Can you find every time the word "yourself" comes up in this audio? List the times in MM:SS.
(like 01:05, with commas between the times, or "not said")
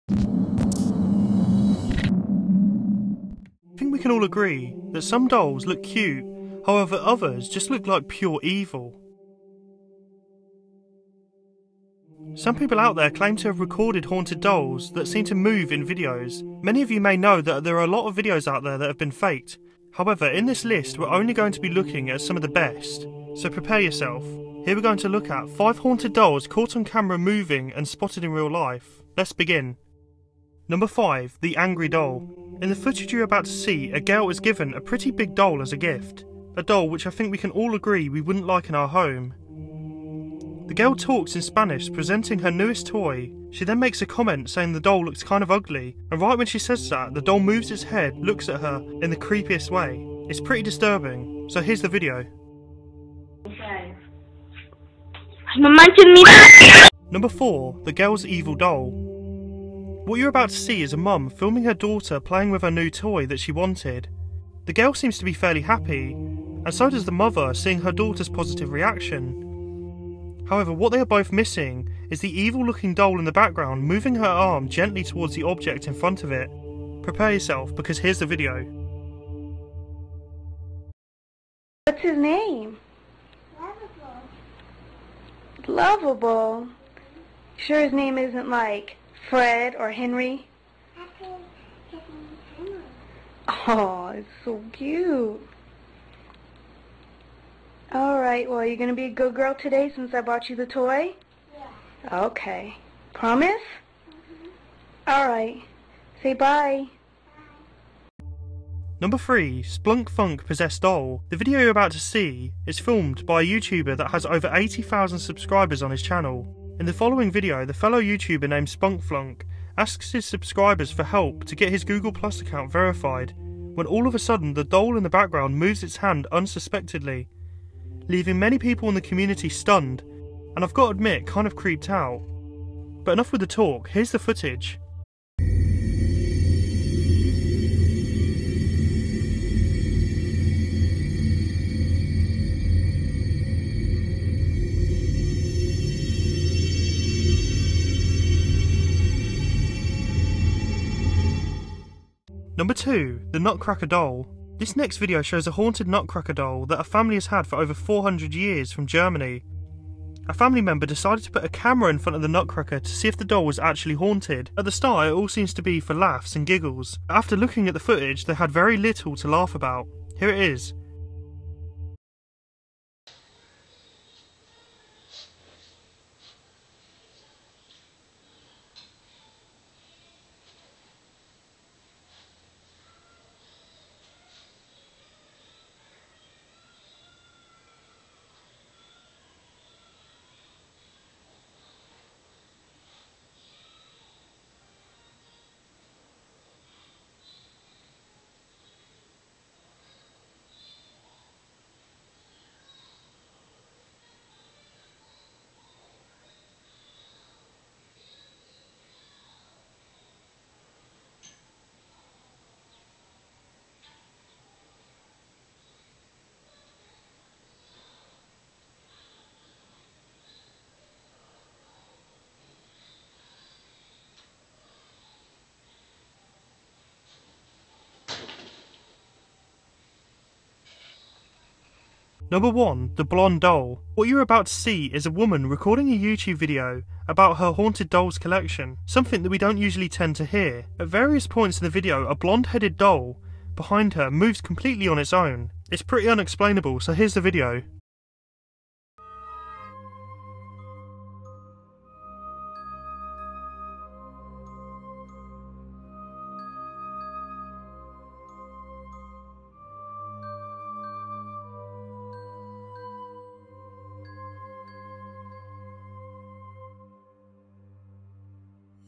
00:23, 01:17.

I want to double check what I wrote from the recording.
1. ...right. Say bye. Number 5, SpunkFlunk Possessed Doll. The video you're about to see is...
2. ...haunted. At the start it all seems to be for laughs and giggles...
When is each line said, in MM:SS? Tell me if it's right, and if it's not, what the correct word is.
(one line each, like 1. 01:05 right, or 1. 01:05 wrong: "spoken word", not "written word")
1. 01:45 wrong: "3", not "5"
2. 02:43 right.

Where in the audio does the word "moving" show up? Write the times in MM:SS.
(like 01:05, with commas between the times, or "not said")
00:27, 01:13.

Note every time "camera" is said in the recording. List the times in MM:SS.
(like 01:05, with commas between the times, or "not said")
00:26, 02:41.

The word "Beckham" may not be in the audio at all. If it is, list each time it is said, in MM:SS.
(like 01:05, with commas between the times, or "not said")
not said.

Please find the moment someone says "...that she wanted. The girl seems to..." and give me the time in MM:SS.
01:03.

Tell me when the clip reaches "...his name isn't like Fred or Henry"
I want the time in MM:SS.
01:27.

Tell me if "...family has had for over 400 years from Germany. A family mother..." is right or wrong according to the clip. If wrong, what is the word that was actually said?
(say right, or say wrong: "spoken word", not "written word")
wrong: "member", not "mother".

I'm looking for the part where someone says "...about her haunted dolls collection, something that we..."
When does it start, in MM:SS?
03:57.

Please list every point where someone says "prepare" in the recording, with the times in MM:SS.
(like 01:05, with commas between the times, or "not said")
00:23, 01:17.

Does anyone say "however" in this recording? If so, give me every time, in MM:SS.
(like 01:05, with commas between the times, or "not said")
00:06, 00:19, 01:10.